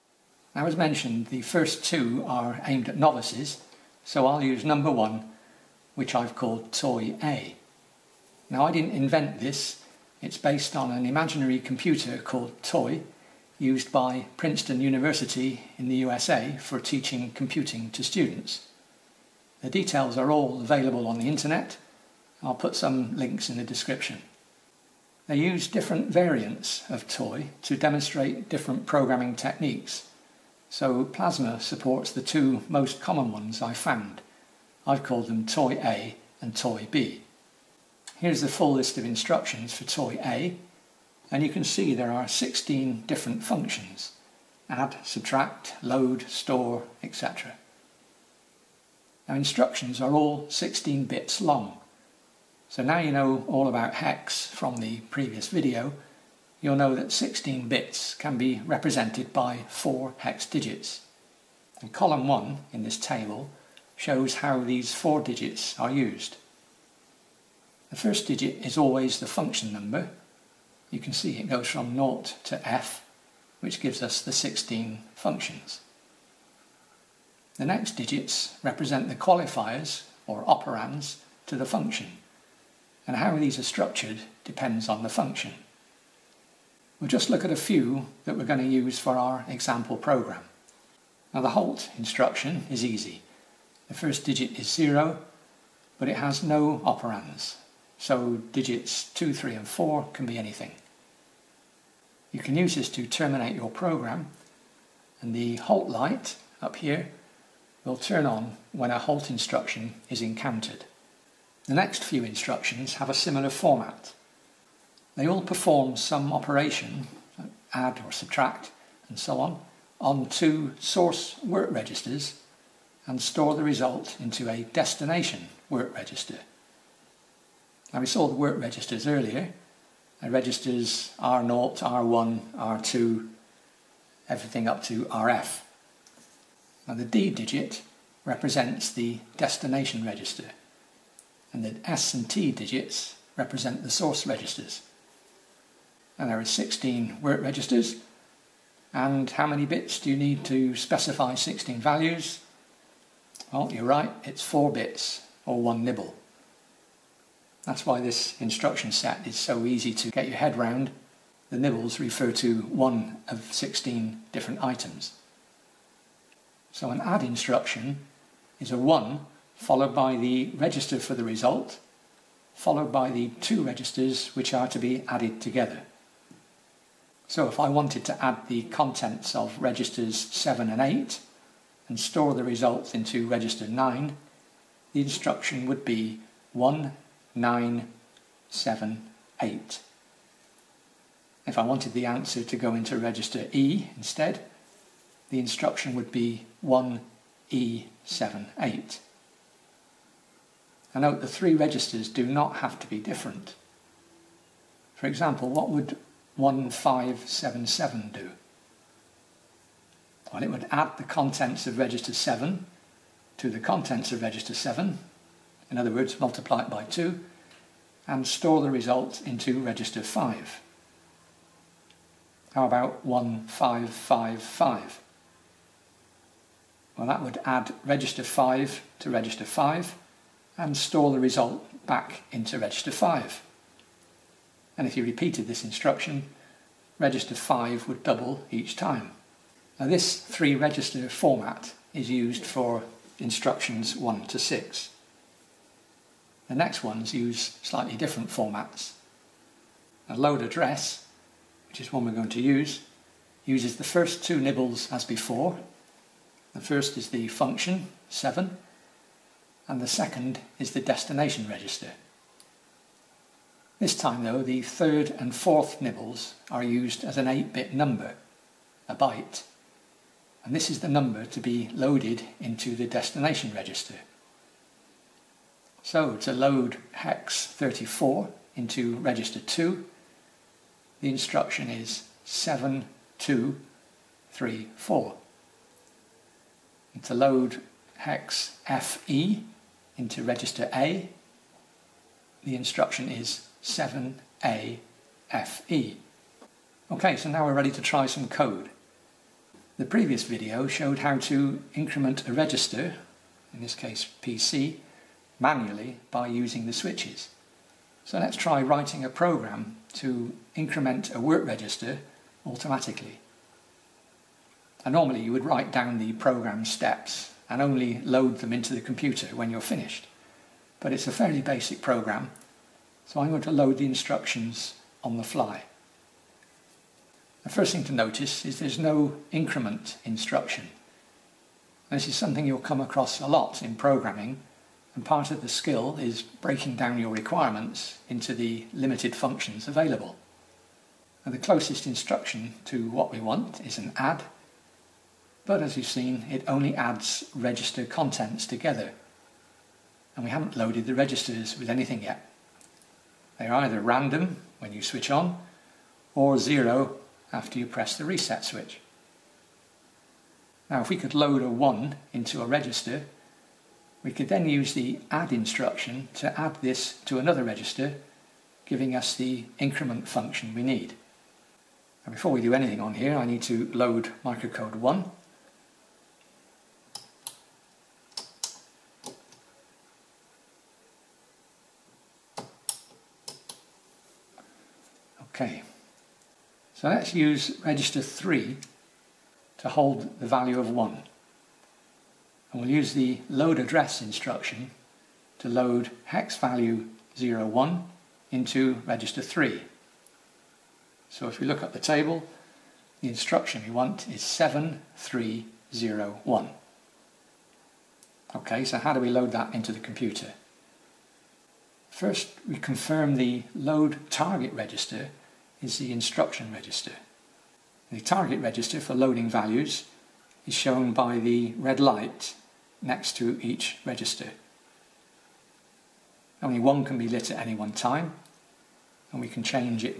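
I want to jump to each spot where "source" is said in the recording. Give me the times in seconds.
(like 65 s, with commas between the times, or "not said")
120 s, 143 s.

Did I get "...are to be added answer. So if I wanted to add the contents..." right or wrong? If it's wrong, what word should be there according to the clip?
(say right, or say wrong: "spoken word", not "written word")
wrong: "together", not "answer".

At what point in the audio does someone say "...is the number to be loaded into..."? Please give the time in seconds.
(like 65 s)
270 s.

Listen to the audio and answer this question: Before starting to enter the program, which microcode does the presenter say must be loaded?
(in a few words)
microcode 1.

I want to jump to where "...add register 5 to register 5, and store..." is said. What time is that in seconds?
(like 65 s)
227 s.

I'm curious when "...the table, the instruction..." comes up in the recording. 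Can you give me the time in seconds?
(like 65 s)
401 s.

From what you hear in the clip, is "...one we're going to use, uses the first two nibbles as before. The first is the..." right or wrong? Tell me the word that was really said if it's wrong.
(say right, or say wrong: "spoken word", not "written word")
right.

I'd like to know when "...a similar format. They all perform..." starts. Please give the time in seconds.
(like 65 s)
113 s.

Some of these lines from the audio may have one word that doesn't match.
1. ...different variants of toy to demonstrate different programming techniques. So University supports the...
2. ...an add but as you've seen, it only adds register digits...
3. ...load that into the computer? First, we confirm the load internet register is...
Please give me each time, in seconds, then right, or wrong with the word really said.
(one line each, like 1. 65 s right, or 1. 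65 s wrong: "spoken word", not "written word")
1. 25 s wrong: "Plasma", not "University"
2. 343 s wrong: "contents", not "digits"
3. 409 s wrong: "target", not "internet".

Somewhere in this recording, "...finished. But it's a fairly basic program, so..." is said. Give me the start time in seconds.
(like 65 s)
319 s.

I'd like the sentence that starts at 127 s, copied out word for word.
Now we saw the work registers earlier.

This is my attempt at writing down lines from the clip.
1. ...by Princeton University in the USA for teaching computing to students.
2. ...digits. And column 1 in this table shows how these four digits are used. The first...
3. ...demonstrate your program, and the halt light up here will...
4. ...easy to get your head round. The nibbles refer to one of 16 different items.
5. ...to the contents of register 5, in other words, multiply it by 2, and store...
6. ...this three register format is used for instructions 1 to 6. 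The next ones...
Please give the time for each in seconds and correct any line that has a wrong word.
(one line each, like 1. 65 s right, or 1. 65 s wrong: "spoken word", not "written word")
1. 13 s right
2. 60 s right
3. 103 s wrong: "terminate", not "demonstrate"
4. 159 s right
5. 213 s wrong: "7", not "5"
6. 239 s right.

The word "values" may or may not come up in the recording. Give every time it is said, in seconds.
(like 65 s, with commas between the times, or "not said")
151 s, 390 s, 396 s, 419 s.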